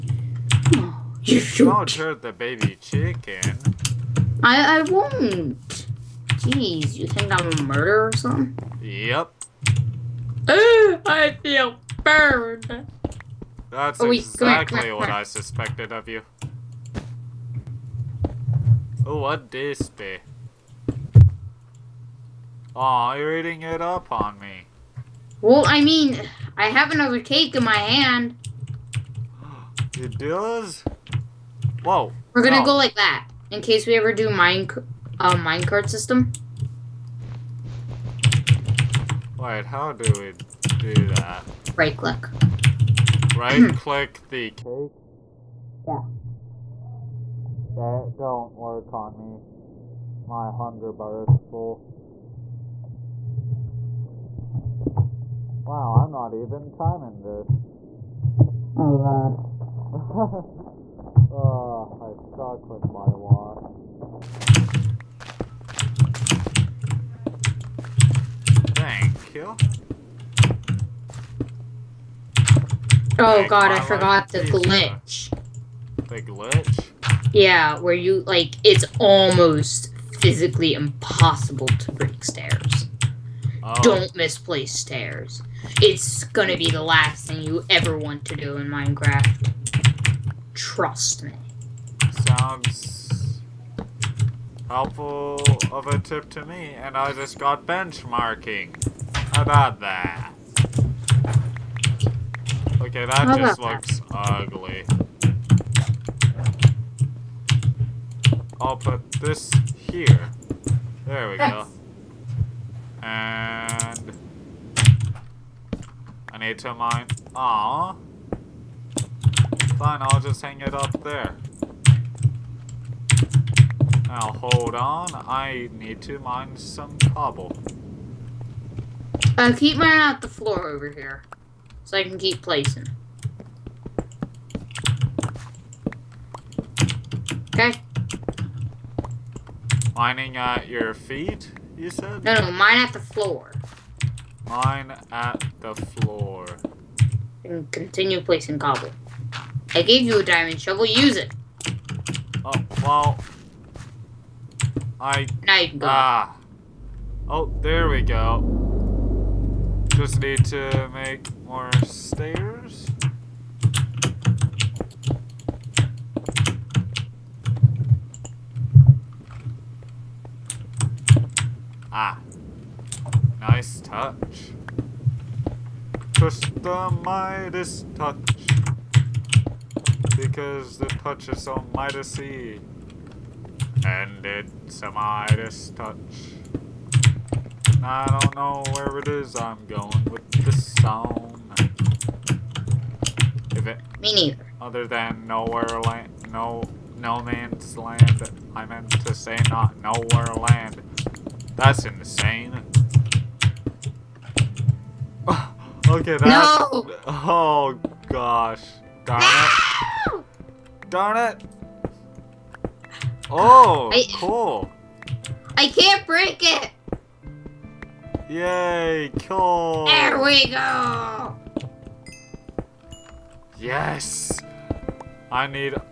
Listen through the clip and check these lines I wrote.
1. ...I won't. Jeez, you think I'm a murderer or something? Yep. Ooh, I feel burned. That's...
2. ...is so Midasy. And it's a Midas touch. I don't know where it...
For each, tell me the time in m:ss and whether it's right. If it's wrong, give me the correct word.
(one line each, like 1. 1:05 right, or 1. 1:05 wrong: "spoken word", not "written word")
1. 0:04 right
2. 3:01 right.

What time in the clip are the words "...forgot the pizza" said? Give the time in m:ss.
1:13.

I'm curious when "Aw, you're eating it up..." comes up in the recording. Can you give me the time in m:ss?
0:22.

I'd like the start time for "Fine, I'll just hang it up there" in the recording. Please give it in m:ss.
1:59.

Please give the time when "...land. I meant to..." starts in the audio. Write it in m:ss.
3:17.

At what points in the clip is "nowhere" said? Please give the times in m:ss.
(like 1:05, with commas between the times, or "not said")
3:15, 3:19.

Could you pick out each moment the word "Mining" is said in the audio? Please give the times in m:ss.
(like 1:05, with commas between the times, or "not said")
2:19.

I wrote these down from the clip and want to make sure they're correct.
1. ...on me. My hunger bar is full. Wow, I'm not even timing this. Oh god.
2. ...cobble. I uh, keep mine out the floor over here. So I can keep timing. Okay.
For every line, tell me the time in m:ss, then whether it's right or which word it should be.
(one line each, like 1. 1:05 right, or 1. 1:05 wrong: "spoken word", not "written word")
1. 0:48 right
2. 2:06 wrong: "placing", not "timing".